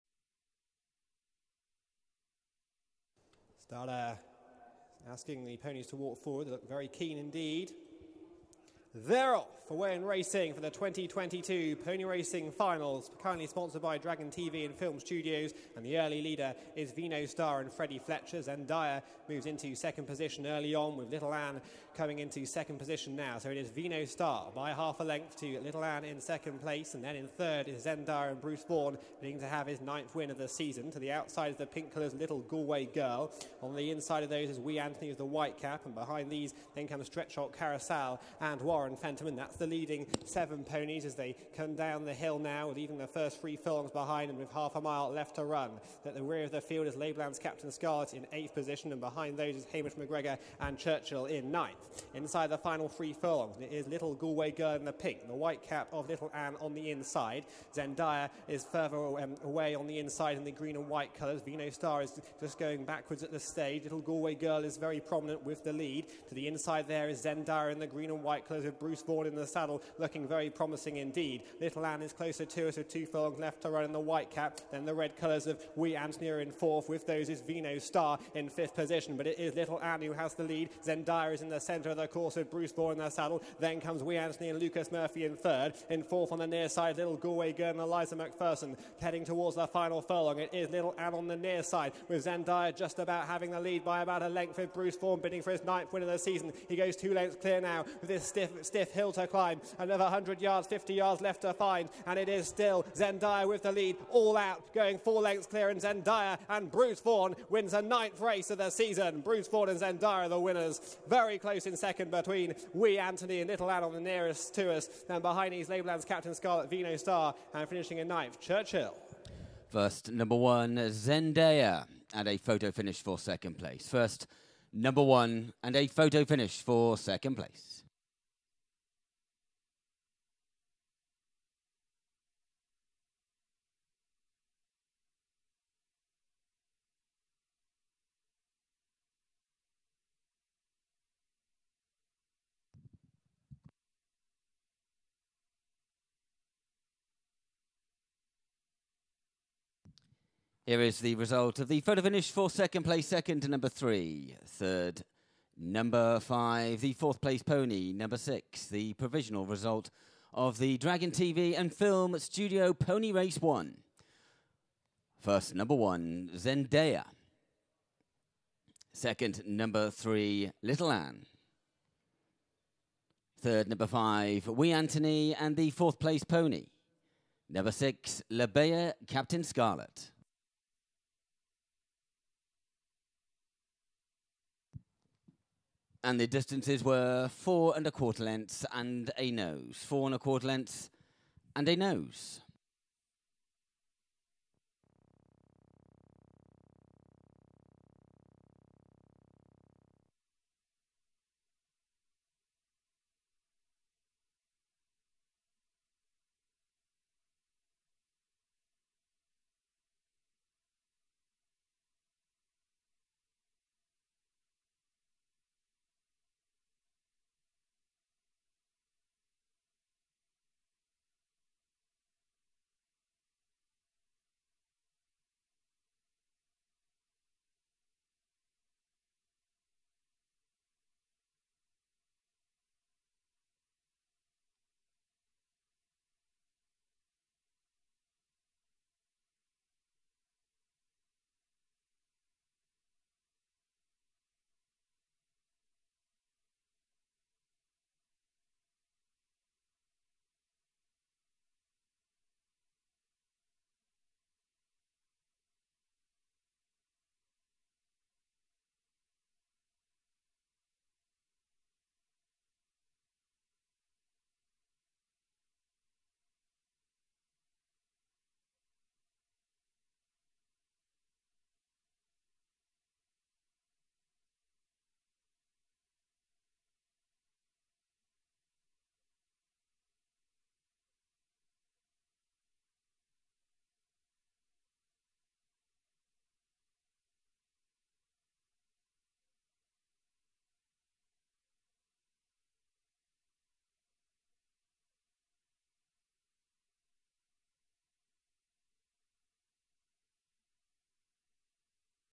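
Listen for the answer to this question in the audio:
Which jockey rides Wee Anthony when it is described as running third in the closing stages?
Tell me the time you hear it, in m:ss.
1:24.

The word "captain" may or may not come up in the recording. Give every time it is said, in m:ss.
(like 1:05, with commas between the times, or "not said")
0:47, 1:56, 2:59.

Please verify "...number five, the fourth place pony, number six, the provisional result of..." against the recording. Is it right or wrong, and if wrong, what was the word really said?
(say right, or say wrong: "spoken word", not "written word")
right.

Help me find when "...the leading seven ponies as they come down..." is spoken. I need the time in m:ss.
0:39.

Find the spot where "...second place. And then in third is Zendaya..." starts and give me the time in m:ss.
0:26.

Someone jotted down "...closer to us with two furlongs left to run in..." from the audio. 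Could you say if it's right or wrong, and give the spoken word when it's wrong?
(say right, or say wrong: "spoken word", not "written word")
right.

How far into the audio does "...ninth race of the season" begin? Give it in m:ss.
1:47.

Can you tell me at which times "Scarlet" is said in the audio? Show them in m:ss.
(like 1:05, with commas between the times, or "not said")
0:47, 1:56, 2:59.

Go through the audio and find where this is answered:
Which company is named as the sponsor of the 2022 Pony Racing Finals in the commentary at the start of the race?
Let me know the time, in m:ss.
0:13.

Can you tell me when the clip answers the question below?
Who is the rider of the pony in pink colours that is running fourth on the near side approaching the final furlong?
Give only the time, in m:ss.
1:27.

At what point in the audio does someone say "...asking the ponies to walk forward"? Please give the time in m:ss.
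0:05.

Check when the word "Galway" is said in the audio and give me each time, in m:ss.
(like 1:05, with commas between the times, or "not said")
0:32, 0:54, 1:03, 1:27.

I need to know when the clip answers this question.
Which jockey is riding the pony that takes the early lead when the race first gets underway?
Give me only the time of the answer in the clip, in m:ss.
0:17.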